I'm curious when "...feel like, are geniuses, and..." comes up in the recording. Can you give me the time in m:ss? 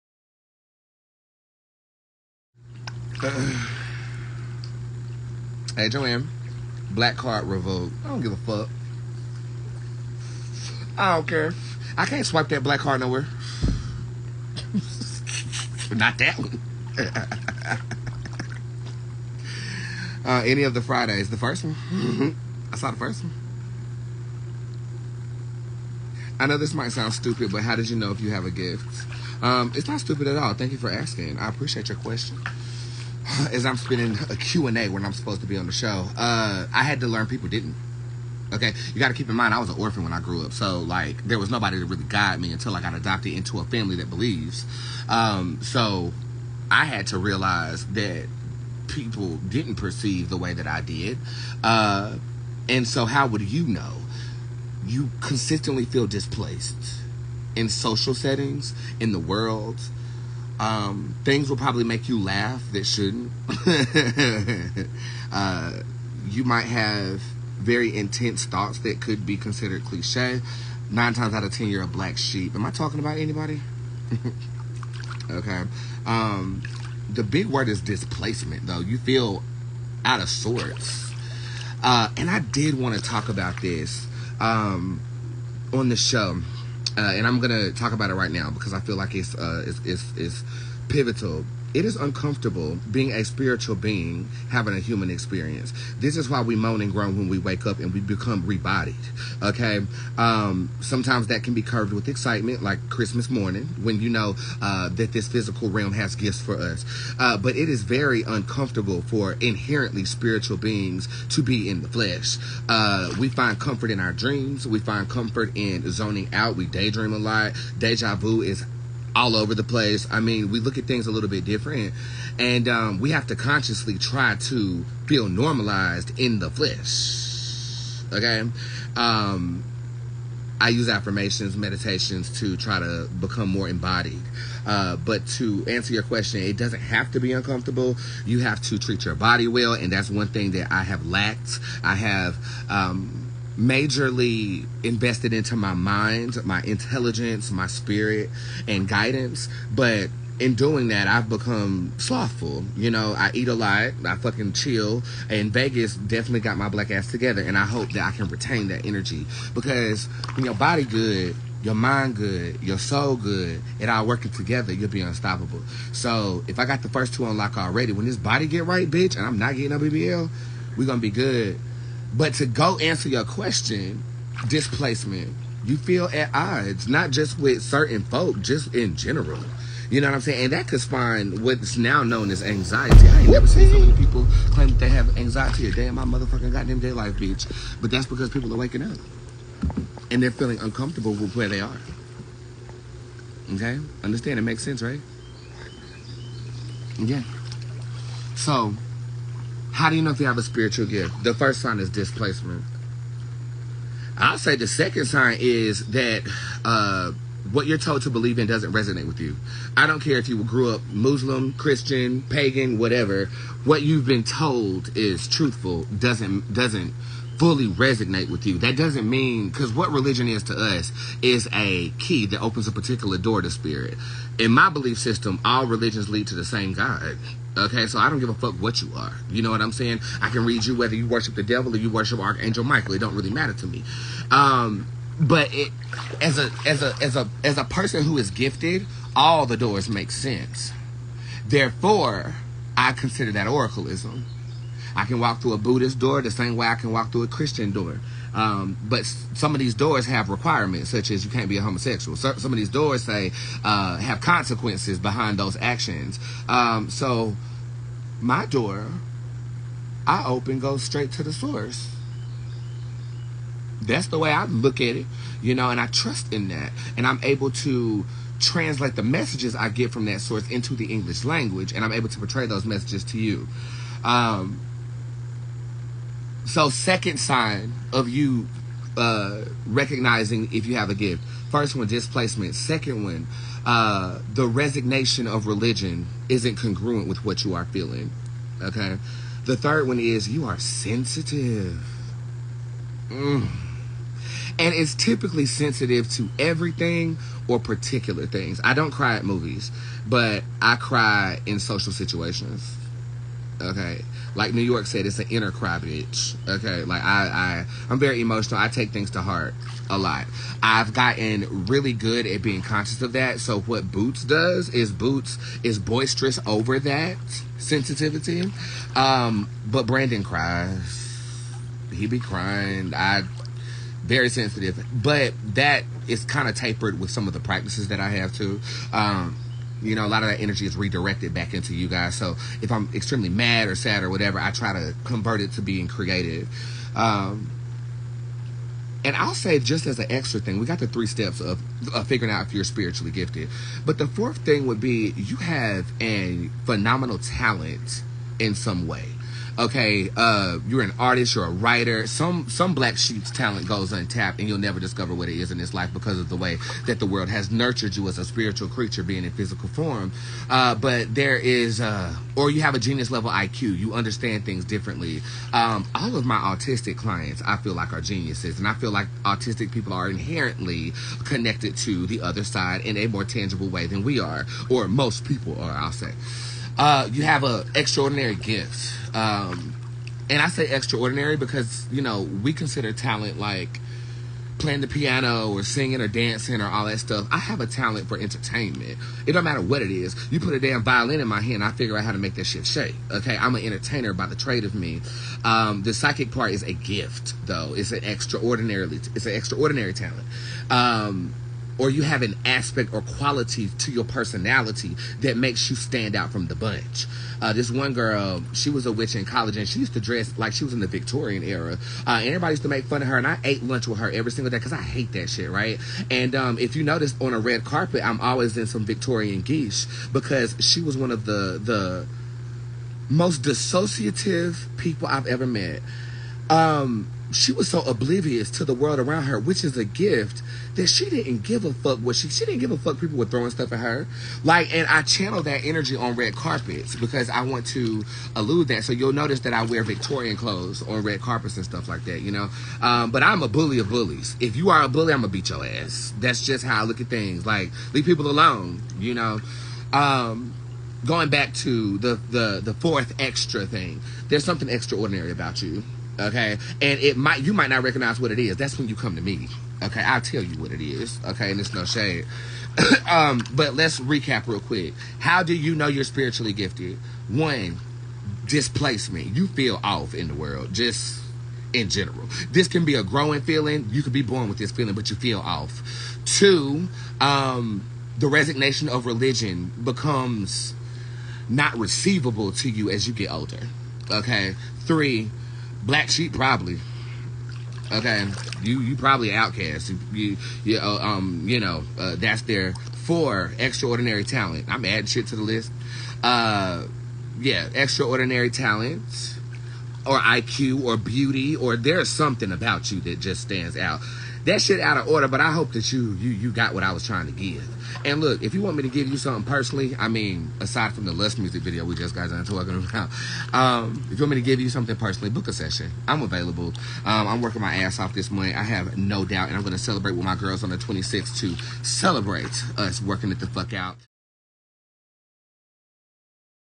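6:07.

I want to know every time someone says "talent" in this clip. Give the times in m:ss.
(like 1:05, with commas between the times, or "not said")
5:47, 5:53, 6:22, 6:27, 6:39, 8:14, 8:18.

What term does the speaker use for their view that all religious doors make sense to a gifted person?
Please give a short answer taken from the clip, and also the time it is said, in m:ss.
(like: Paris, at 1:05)
oracleism, at 4:03.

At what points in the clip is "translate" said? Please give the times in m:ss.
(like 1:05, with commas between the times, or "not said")
4:28.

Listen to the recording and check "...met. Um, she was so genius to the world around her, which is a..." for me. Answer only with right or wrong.
wrong.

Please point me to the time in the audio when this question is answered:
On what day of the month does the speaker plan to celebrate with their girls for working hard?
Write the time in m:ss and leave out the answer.
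8:40.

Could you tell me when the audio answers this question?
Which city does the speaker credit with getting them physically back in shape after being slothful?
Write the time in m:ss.
2:35.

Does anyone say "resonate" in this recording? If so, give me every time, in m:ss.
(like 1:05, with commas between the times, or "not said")
3:28, 3:37.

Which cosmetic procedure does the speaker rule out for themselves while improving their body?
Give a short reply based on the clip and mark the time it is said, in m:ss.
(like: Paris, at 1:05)
BBL, at 2:49.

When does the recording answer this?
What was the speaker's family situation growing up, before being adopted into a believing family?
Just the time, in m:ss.
0:39.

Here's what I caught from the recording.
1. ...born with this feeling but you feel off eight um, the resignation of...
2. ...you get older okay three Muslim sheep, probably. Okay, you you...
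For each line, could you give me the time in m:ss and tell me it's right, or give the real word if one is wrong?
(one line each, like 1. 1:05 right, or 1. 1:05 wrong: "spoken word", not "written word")
1. 7:54 wrong: "two", not "eight"
2. 8:03 wrong: "Black", not "Muslim".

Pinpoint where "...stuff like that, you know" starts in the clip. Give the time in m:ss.
7:21.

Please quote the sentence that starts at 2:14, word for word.
Uh, but to answer your question, it doesn't have to be uncomfortable.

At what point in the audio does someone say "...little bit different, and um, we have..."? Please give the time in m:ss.
2:01.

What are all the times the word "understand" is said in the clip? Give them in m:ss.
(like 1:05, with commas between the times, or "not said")
3:14, 6:03.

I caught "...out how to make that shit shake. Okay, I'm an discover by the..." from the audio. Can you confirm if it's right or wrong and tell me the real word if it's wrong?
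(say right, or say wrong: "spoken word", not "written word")
wrong: "entertainer", not "discover".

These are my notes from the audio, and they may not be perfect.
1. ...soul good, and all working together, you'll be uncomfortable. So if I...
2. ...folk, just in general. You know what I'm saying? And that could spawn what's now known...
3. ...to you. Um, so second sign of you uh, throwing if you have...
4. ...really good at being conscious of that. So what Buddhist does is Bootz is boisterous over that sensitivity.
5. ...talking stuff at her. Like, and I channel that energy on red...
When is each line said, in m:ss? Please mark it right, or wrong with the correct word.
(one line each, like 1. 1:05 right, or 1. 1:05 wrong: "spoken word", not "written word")
1. 2:42 wrong: "unstoppable", not "uncomfortable"
2. 2:58 right
3. 4:33 wrong: "recognizing", not "throwing"
4. 5:11 wrong: "Bootz", not "Buddhist"
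5. 7:13 wrong: "throwing", not "talking".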